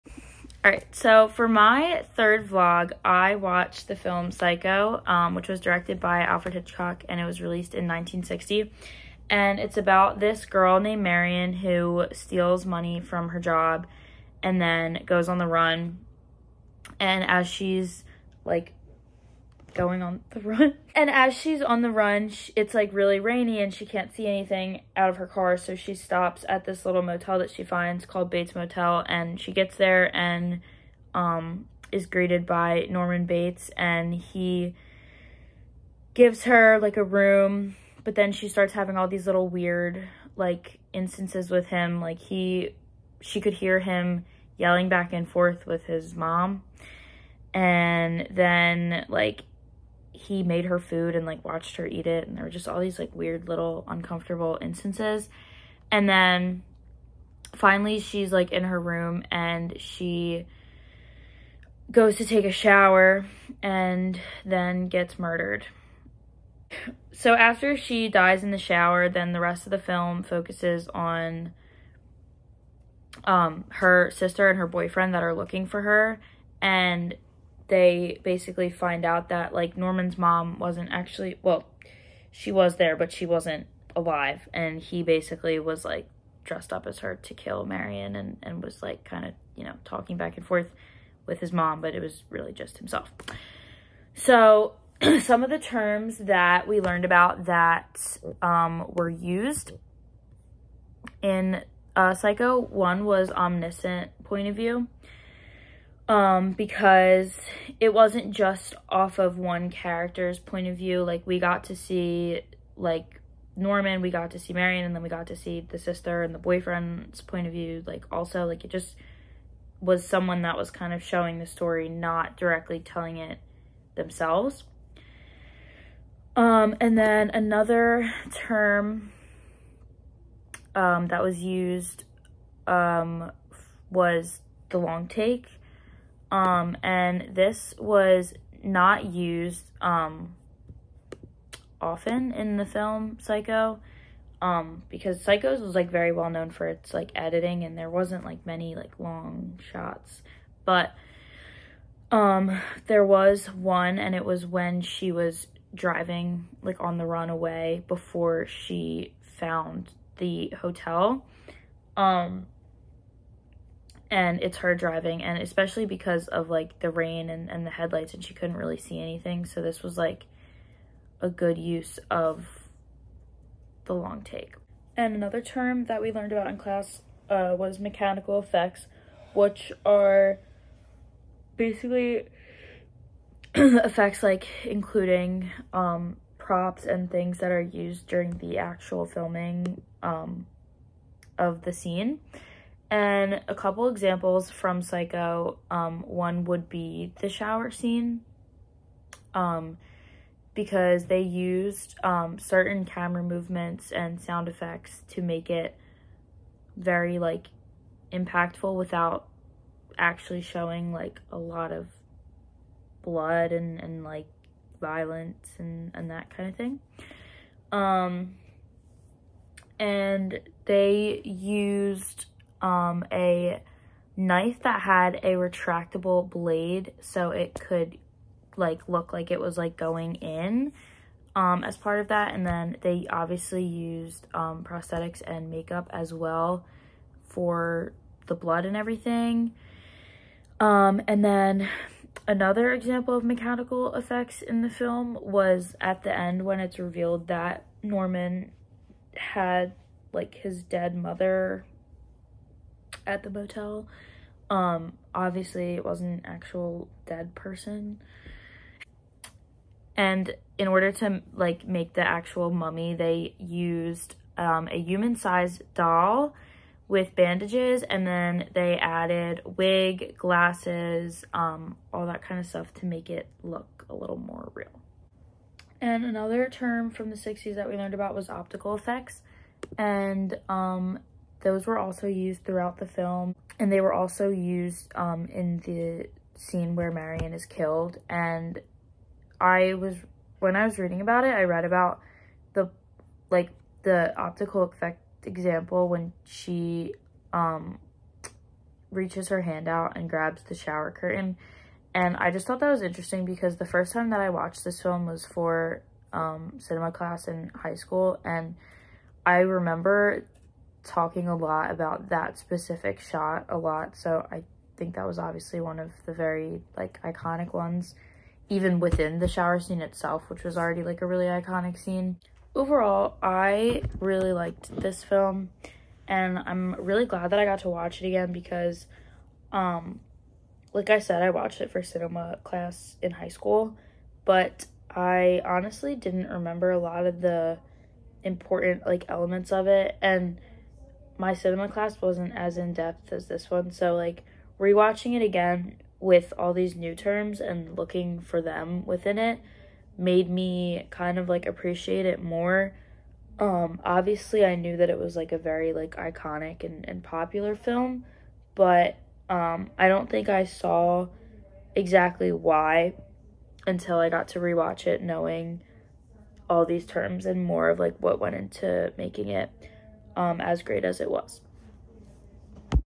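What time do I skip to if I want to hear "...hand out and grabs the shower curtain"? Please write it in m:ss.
4:59.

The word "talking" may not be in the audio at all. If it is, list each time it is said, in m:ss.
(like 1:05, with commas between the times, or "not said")
1:29, 5:10.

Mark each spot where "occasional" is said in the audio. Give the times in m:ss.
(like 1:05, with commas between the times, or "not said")
not said.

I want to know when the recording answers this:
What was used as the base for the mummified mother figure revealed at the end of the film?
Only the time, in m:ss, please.
4:24.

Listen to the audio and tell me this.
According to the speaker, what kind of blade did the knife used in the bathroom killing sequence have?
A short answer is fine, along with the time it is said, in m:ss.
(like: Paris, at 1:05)
retractable, at 3:45.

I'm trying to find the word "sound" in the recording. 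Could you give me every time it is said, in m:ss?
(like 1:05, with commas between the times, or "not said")
3:24.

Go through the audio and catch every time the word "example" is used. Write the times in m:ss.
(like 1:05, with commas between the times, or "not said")
3:13, 4:02, 4:55.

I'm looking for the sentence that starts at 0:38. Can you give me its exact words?
But then she starts having all these little weird like instances with him.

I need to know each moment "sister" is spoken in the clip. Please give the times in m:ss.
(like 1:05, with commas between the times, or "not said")
1:14, 1:55.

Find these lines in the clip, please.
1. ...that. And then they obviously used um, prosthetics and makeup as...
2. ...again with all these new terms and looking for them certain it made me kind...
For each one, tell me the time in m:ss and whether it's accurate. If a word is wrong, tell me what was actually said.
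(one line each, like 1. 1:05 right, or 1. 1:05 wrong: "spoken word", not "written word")
1. 3:52 right
2. 5:45 wrong: "within", not "certain".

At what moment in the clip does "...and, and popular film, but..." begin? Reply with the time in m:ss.
5:56.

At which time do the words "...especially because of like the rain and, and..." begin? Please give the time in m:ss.
2:45.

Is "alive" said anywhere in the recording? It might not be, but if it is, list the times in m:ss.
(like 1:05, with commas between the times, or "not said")
1:23.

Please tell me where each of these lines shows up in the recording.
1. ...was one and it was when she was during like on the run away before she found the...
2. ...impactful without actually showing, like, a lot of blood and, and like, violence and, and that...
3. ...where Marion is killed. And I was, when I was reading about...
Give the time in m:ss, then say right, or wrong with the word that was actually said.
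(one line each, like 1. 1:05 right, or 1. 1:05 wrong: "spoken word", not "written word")
1. 2:33 wrong: "driving", not "during"
2. 3:28 right
3. 4:46 right.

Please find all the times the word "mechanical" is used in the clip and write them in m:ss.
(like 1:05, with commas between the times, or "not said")
2:57, 4:03.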